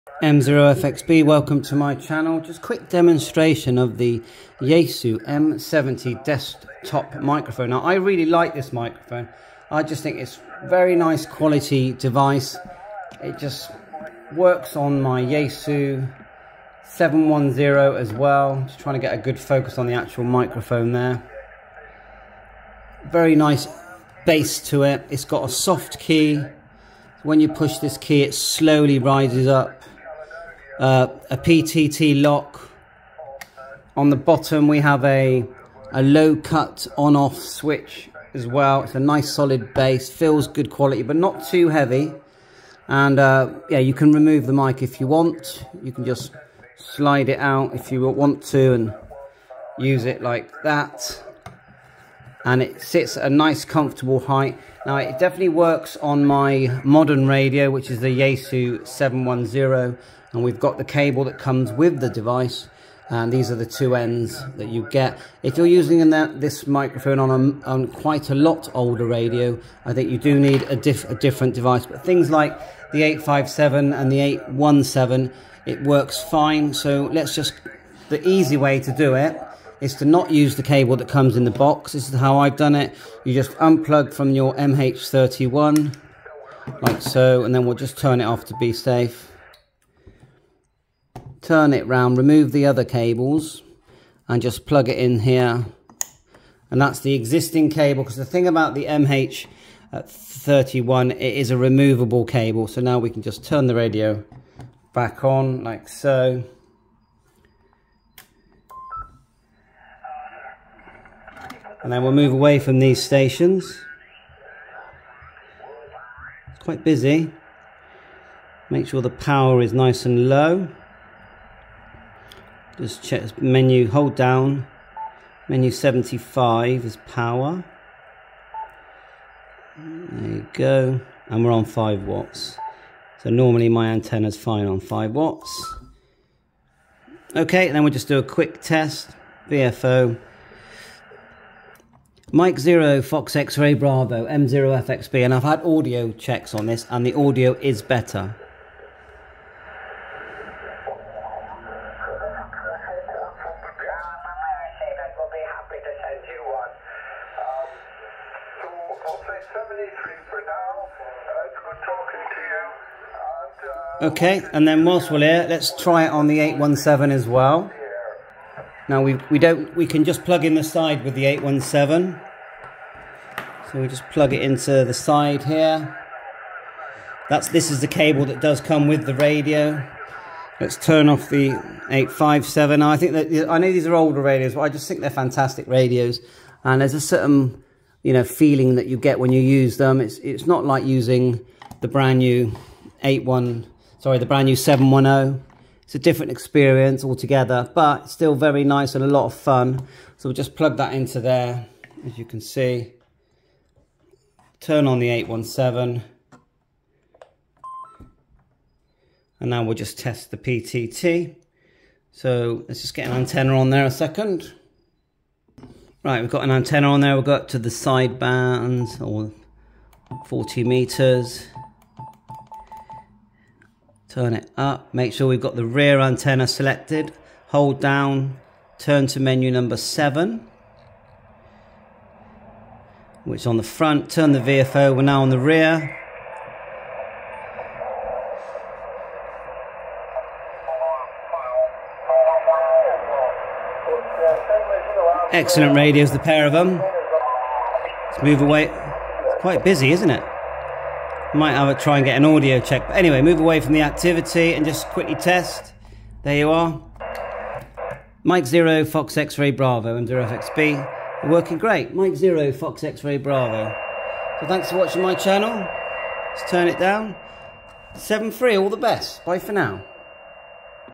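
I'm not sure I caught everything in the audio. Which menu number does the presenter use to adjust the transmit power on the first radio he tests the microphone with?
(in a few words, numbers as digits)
75.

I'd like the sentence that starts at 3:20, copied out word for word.
So we'll just plug that into there, as you can see.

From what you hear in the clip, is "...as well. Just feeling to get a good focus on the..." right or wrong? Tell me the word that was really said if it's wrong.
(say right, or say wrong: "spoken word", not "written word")
wrong: "trying", not "feeling".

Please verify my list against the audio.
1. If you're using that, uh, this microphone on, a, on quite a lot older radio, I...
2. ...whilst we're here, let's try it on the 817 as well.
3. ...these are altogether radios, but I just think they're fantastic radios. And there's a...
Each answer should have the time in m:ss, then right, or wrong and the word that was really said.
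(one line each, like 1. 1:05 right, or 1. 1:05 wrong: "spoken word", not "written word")
1. 1:05 right
2. 2:44 right
3. 3:03 wrong: "older", not "altogether".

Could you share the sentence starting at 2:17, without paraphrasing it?
Okay, then we'll just do a quick test.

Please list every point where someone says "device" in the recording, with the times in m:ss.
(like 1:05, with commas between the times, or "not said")
0:11, 1:02, 1:11.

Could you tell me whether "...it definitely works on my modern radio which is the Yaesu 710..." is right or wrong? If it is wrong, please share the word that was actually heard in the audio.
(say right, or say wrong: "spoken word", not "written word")
right.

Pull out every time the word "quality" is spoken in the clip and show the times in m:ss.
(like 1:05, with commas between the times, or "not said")
0:11, 0:40.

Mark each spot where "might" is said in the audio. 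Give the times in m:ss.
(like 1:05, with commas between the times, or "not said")
4:11.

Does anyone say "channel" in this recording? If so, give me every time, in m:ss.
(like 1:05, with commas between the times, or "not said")
0:01, 4:25.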